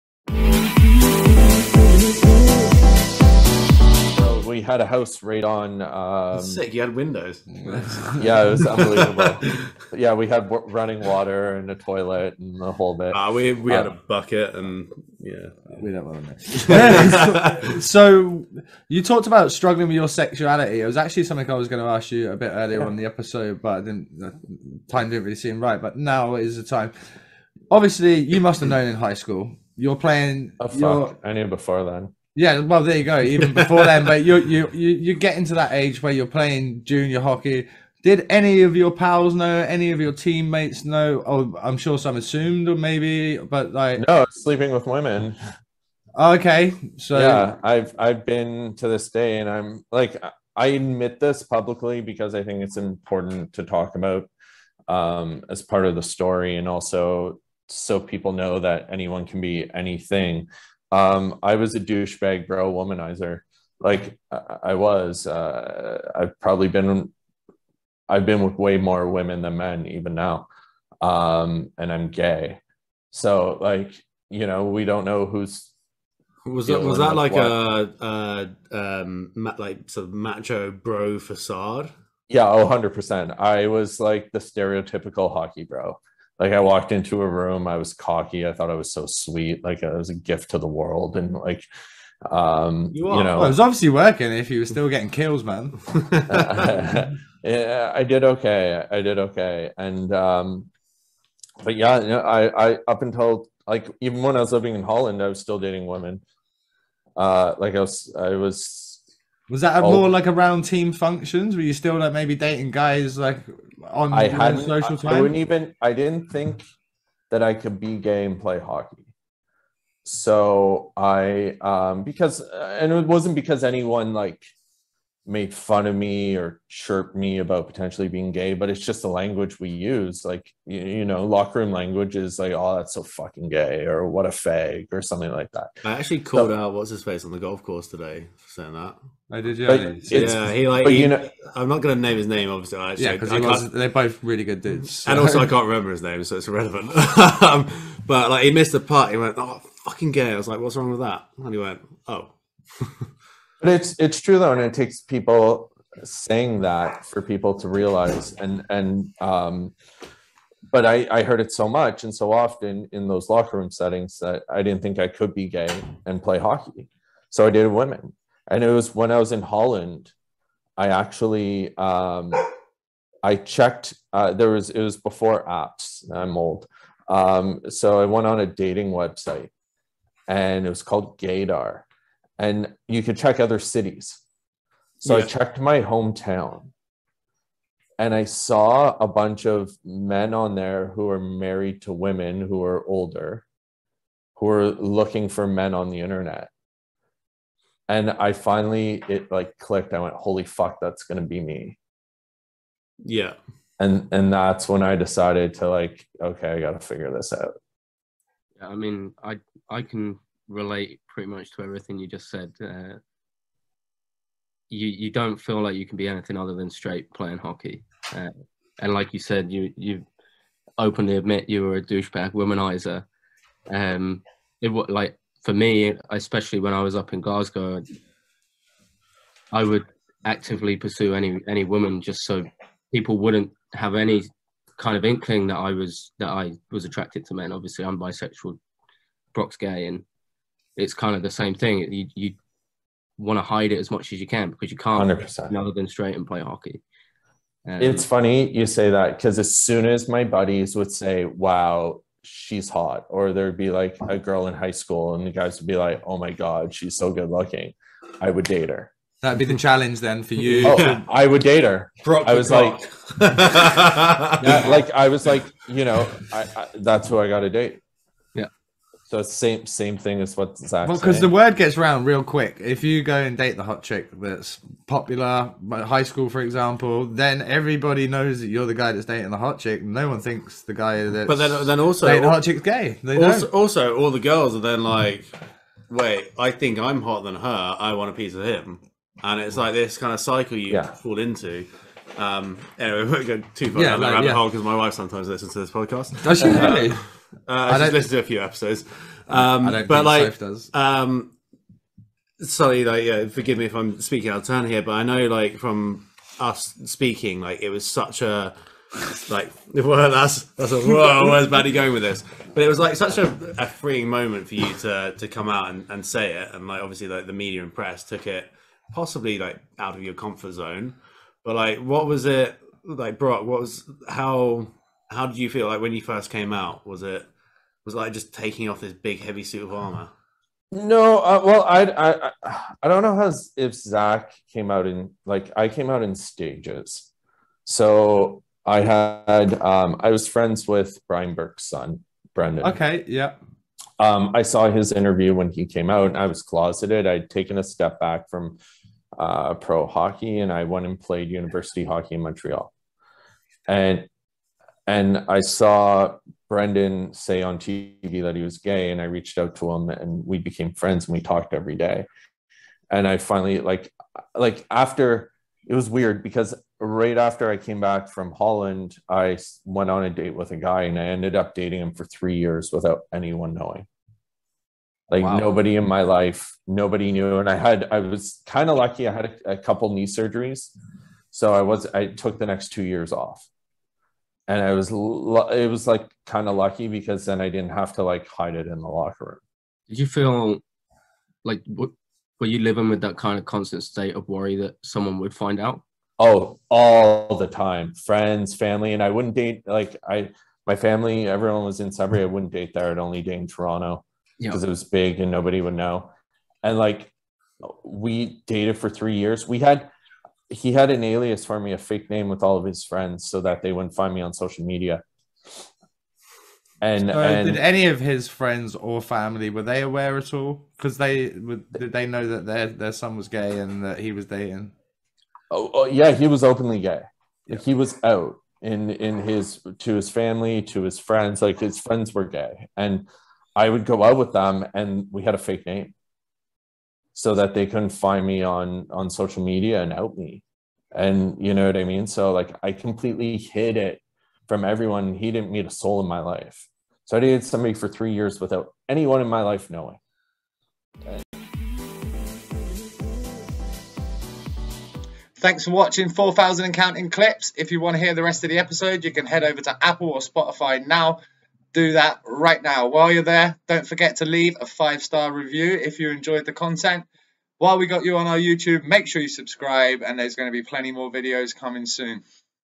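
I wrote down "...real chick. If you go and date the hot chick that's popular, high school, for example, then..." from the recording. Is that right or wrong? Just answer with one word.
wrong.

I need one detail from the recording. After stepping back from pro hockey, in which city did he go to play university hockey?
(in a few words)
Montreal.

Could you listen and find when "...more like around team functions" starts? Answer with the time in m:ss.
1:49.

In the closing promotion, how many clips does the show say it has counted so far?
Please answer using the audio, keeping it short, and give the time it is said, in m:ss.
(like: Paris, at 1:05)
4,000, at 7:36.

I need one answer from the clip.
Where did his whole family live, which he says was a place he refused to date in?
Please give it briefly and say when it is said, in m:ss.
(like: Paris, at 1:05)
Sudbury, at 6:41.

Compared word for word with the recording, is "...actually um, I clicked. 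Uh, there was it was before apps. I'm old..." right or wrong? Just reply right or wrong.
wrong.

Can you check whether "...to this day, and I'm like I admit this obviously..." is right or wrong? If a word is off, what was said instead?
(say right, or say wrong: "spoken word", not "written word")
wrong: "publicly", not "obviously".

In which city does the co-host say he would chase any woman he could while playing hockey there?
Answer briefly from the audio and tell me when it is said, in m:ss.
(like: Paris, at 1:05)
Glasgow, at 3:47.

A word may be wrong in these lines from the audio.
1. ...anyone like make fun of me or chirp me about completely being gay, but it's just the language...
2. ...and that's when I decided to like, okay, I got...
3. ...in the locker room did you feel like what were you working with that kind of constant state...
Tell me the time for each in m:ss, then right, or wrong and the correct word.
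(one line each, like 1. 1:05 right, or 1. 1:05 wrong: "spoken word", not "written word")
1. 2:03 wrong: "potentially", not "completely"
2. 3:24 right
3. 6:28 wrong: "living", not "working".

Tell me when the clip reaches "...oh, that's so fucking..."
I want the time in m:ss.
2:12.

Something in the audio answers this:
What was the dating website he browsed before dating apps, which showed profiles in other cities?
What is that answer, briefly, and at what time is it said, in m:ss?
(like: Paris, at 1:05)
Gaydar, at 3:01.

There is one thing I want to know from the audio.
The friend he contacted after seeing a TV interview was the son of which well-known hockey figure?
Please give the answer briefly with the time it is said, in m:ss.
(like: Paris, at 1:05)
Brian Burke, at 5:41.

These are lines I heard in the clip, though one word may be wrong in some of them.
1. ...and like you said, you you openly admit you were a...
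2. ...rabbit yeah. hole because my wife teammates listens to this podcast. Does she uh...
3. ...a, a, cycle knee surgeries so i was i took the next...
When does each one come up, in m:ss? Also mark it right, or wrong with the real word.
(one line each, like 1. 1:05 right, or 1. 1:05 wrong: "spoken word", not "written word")
1. 3:38 right
2. 4:54 wrong: "sometimes", not "teammates"
3. 6:19 wrong: "couple", not "cycle".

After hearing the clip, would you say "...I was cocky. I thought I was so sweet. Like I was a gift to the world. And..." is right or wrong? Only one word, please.
right.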